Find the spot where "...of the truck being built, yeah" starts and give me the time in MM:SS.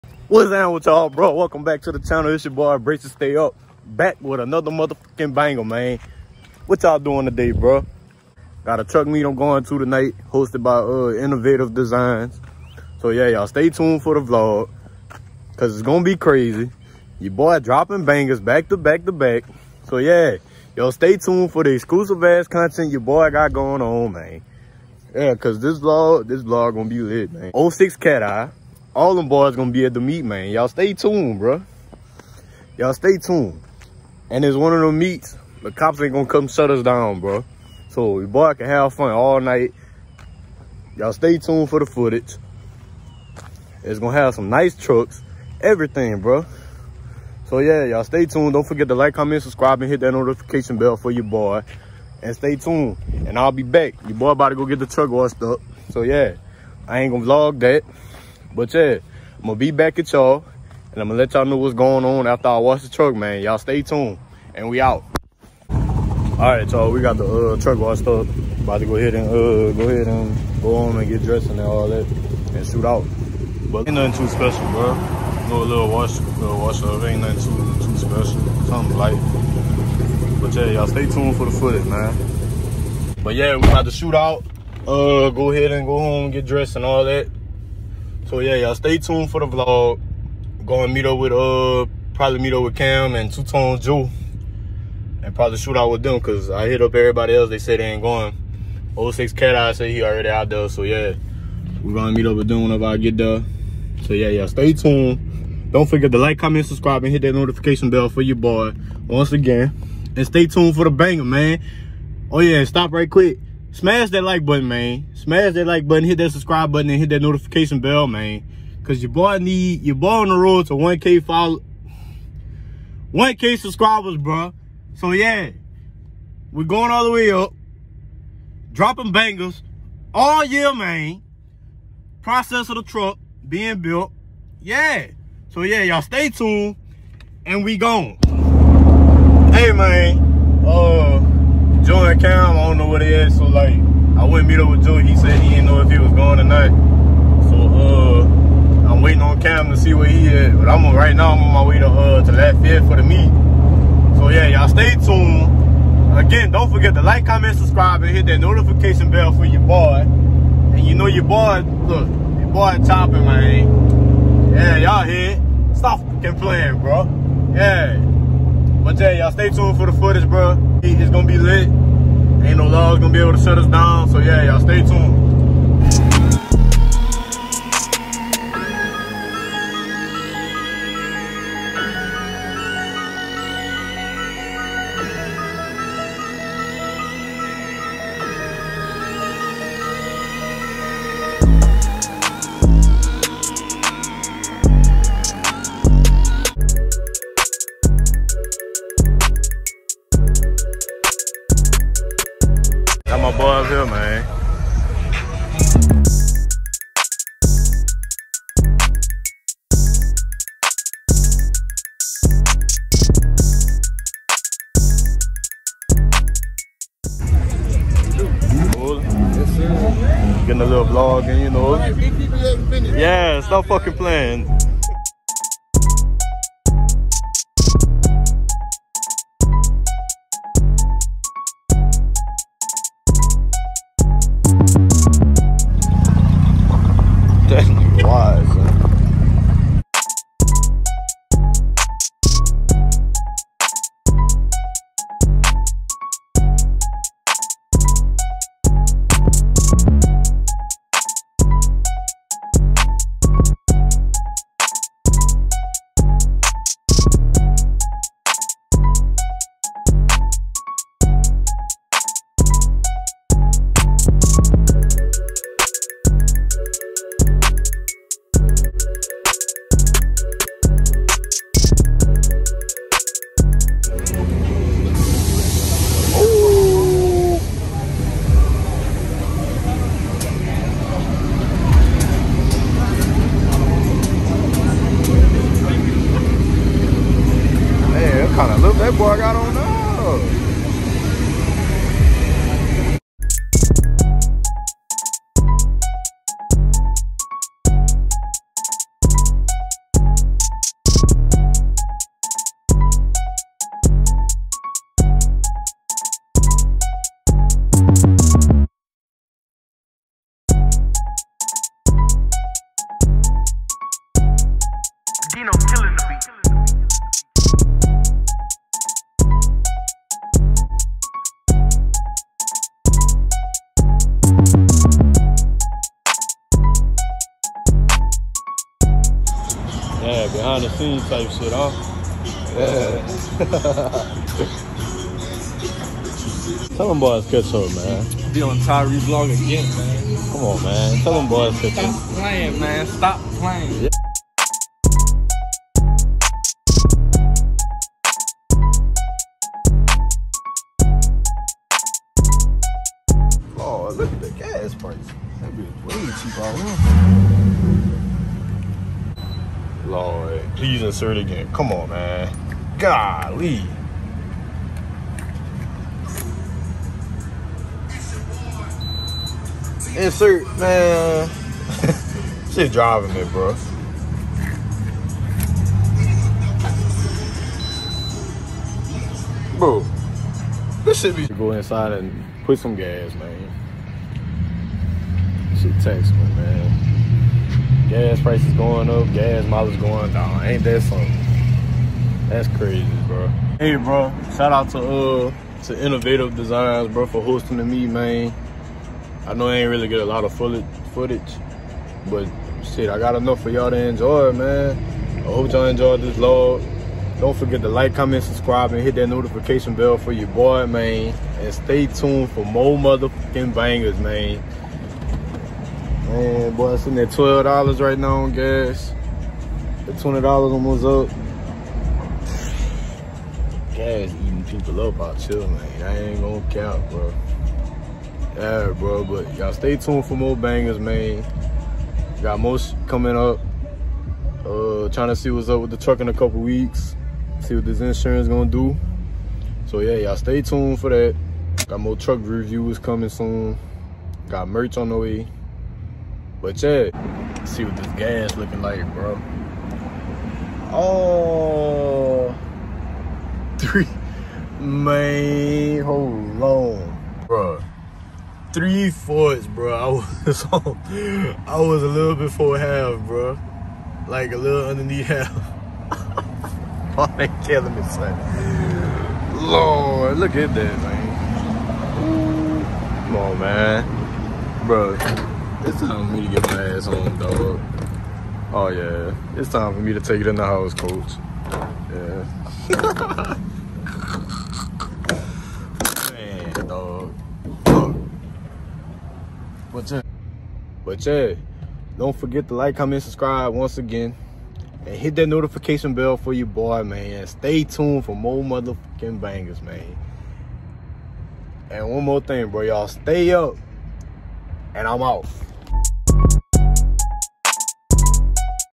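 02:12.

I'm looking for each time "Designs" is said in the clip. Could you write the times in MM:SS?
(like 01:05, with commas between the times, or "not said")
00:11, 06:36.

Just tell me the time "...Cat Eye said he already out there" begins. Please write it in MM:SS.
01:39.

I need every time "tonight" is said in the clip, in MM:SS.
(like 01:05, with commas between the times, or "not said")
00:09, 02:26.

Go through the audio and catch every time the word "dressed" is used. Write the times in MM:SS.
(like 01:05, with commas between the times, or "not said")
01:11, 01:26.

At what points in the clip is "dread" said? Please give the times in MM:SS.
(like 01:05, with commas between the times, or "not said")
not said.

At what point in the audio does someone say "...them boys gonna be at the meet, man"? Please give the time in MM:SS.
00:29.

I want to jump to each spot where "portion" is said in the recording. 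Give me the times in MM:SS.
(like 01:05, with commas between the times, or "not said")
not said.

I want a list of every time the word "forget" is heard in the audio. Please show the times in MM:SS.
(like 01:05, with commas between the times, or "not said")
00:48, 01:45, 02:36, 06:47, 08:12.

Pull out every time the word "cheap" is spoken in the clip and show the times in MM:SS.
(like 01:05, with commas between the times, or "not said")
05:56.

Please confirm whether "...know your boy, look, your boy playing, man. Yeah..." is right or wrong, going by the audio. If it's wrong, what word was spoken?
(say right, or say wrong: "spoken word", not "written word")
wrong: "chopping", not "playing".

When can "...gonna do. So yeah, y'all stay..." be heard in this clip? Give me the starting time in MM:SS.
07:18.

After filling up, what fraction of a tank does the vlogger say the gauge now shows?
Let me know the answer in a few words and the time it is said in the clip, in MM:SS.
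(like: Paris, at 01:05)
Three fourths, at 07:38.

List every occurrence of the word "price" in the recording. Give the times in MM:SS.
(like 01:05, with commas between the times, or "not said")
05:54, 06:28.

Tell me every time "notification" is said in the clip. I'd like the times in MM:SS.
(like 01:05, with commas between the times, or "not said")
00:50, 01:47, 01:57, 02:38, 06:49, 08:15.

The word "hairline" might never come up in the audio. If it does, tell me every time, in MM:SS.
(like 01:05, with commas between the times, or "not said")
not said.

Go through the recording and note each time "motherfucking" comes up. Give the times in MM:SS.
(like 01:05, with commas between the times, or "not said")
00:04, 06:52, 08:18.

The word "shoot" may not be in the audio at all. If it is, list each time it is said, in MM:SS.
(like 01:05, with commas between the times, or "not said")
01:12, 01:23, 01:35.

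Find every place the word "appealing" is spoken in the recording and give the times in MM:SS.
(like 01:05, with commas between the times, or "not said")
not said.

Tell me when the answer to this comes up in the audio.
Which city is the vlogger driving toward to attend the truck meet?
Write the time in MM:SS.
02:32.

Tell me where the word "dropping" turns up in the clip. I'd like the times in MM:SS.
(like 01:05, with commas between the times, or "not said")
00:17, 02:08.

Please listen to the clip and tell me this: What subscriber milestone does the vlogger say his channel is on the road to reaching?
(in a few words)
1K subscribers.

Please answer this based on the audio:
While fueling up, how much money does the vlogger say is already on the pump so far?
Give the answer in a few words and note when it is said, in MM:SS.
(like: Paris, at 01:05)
$12, at 06:57.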